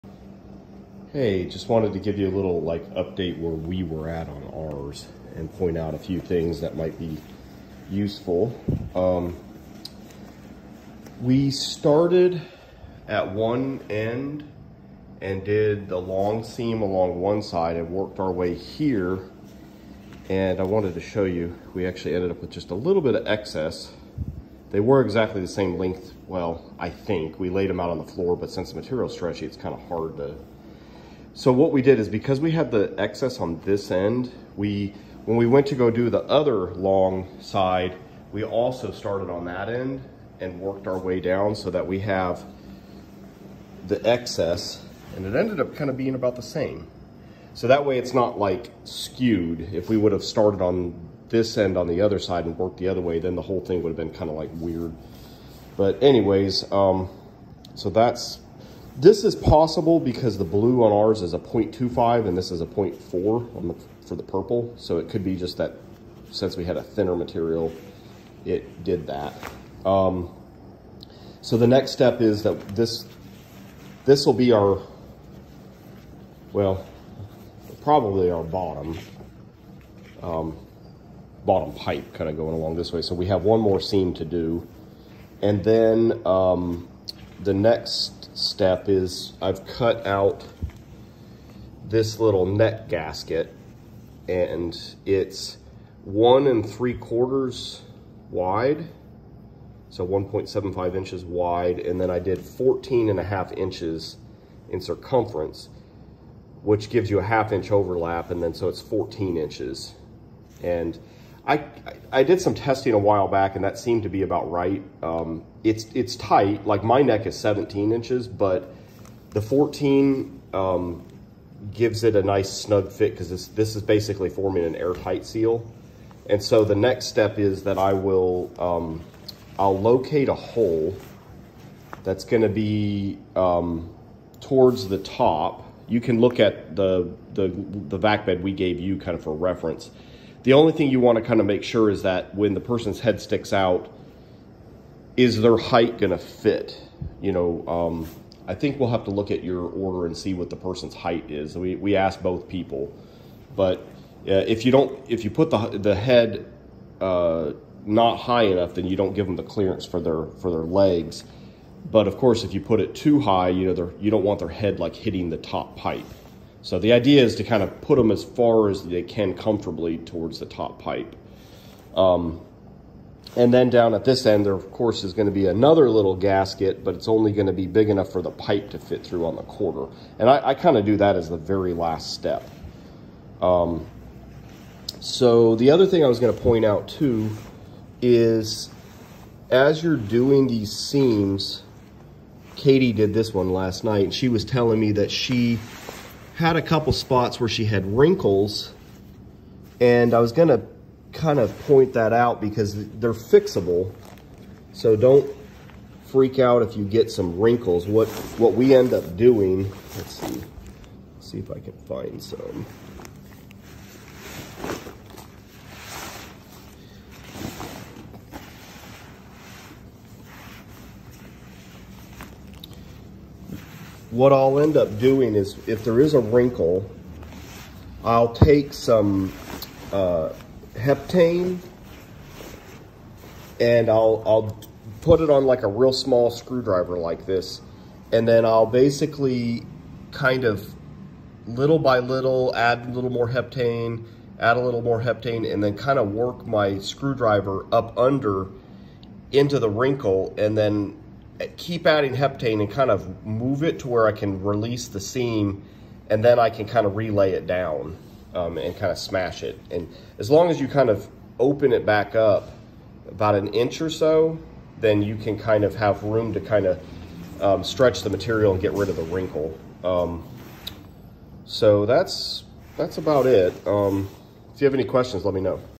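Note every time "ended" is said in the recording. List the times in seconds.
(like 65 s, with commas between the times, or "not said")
22 s, 45 s.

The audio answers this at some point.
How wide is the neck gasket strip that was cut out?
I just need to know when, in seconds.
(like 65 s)
100 s.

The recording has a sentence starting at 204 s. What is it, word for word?
So don't freak out if you get some wrinkles.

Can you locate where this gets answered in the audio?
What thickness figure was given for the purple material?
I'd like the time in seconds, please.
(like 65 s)
62 s.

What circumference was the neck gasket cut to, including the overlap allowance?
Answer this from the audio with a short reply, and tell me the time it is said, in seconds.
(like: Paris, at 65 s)
14.5 inches, at 102 s.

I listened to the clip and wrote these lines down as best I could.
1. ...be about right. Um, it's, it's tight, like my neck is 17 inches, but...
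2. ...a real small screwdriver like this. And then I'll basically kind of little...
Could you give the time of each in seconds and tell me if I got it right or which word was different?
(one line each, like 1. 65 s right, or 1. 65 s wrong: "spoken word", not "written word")
1. 114 s right
2. 235 s right.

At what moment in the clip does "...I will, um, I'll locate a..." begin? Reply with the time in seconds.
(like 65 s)
127 s.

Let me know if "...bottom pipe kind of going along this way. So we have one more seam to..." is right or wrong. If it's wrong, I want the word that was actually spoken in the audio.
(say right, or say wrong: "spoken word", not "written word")
right.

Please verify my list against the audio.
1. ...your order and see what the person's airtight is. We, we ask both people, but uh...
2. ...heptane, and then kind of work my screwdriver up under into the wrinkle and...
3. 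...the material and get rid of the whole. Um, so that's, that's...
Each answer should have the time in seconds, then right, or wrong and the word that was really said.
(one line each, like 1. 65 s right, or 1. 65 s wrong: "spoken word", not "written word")
1. 149 s wrong: "height", not "airtight"
2. 245 s right
3. 268 s wrong: "wrinkle", not "whole".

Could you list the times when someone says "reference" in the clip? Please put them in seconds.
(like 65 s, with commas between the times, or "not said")
139 s.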